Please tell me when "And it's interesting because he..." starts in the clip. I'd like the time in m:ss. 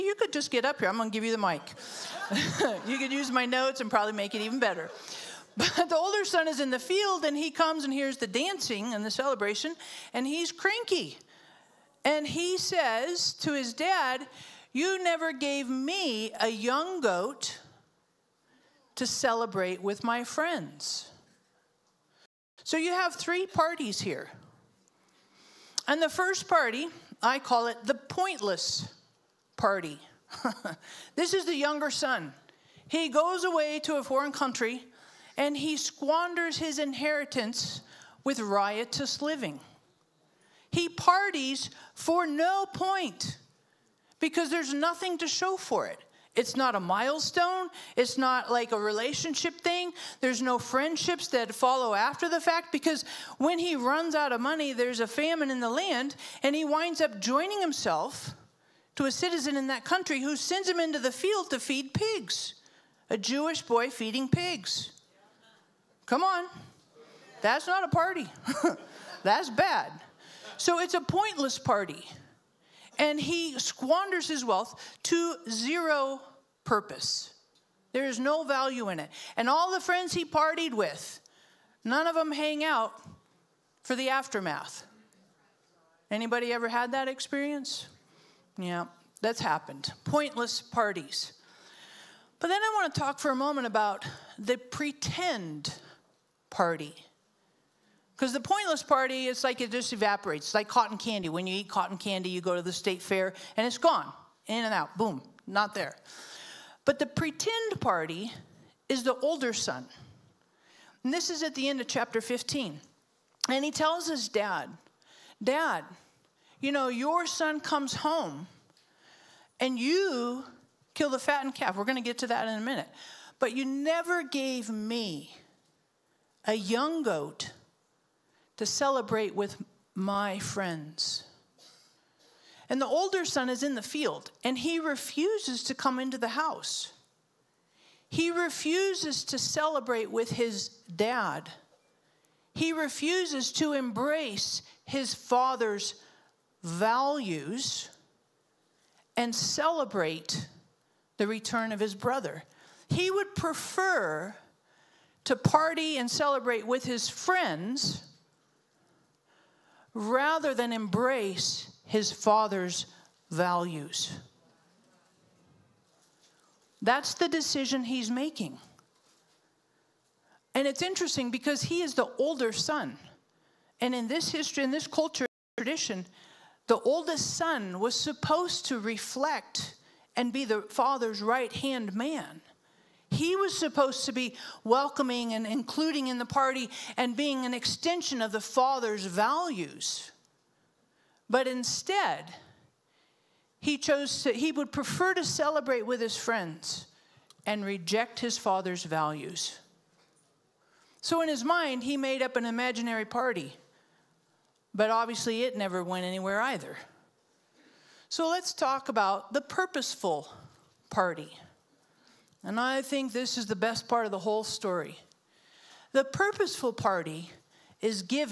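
2:50.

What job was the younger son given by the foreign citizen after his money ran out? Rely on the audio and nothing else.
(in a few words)
feed pigs.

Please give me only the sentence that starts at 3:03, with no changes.
He was supposed to be welcoming and including in the party and being an extension of the Father's values.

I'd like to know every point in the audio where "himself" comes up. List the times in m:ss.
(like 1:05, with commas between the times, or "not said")
0:57.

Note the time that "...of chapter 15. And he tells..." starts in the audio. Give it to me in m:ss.
1:51.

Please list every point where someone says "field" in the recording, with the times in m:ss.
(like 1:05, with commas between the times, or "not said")
0:06, 1:01, 2:13.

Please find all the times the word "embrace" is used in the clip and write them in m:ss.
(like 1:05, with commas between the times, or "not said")
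2:23, 2:40.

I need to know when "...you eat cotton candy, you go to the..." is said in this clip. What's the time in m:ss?
1:41.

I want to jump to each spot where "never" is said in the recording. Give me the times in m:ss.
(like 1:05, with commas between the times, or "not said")
0:15, 2:03, 3:25.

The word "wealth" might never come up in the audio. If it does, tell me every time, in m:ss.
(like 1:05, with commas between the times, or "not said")
1:14.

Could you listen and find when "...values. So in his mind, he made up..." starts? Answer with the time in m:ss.
3:18.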